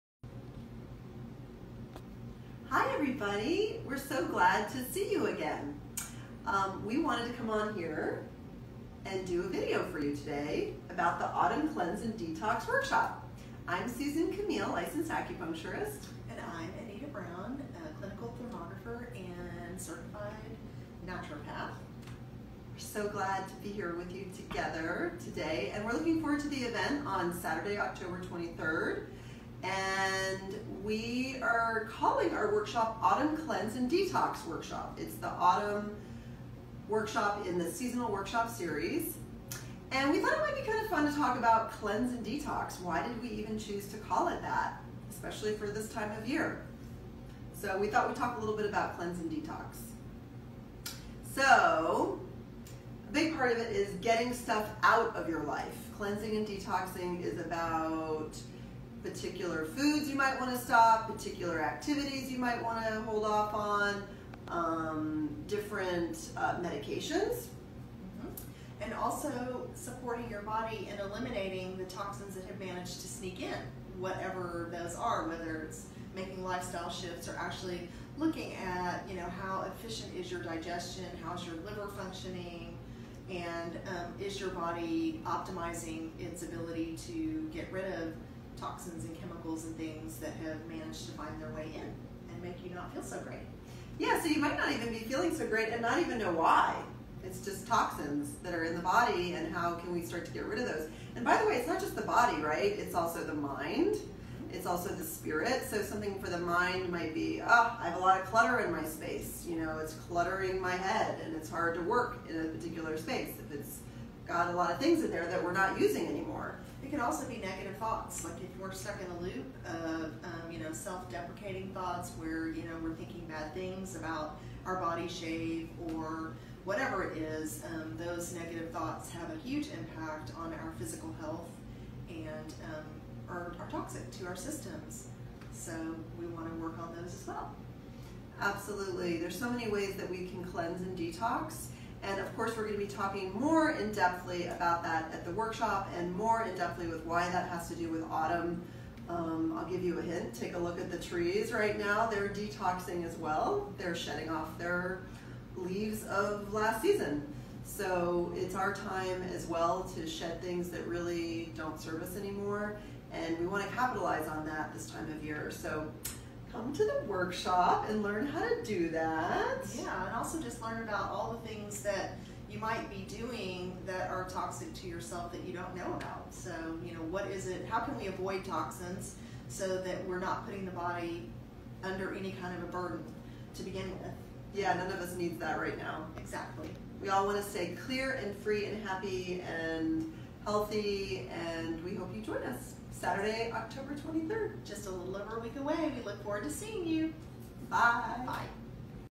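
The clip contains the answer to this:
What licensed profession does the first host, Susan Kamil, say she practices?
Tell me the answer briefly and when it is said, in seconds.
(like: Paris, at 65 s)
Acupuncturist, at 14 s.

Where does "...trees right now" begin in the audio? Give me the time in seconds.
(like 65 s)
150 s.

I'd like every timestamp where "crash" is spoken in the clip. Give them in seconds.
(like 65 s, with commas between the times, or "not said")
not said.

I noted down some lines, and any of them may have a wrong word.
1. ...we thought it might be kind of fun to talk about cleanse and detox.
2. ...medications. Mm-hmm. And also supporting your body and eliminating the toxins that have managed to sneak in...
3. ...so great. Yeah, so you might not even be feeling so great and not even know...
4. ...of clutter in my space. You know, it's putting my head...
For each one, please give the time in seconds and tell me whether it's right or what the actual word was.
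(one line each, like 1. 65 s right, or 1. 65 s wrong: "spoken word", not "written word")
1. 40 s right
2. 66 s right
3. 93 s right
4. 108 s wrong: "cluttering", not "putting".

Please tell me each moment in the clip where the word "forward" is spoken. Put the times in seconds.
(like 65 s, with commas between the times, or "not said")
26 s, 196 s.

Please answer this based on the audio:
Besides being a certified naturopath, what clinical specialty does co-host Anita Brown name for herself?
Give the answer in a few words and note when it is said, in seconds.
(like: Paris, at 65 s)
Clinical thermographer, at 17 s.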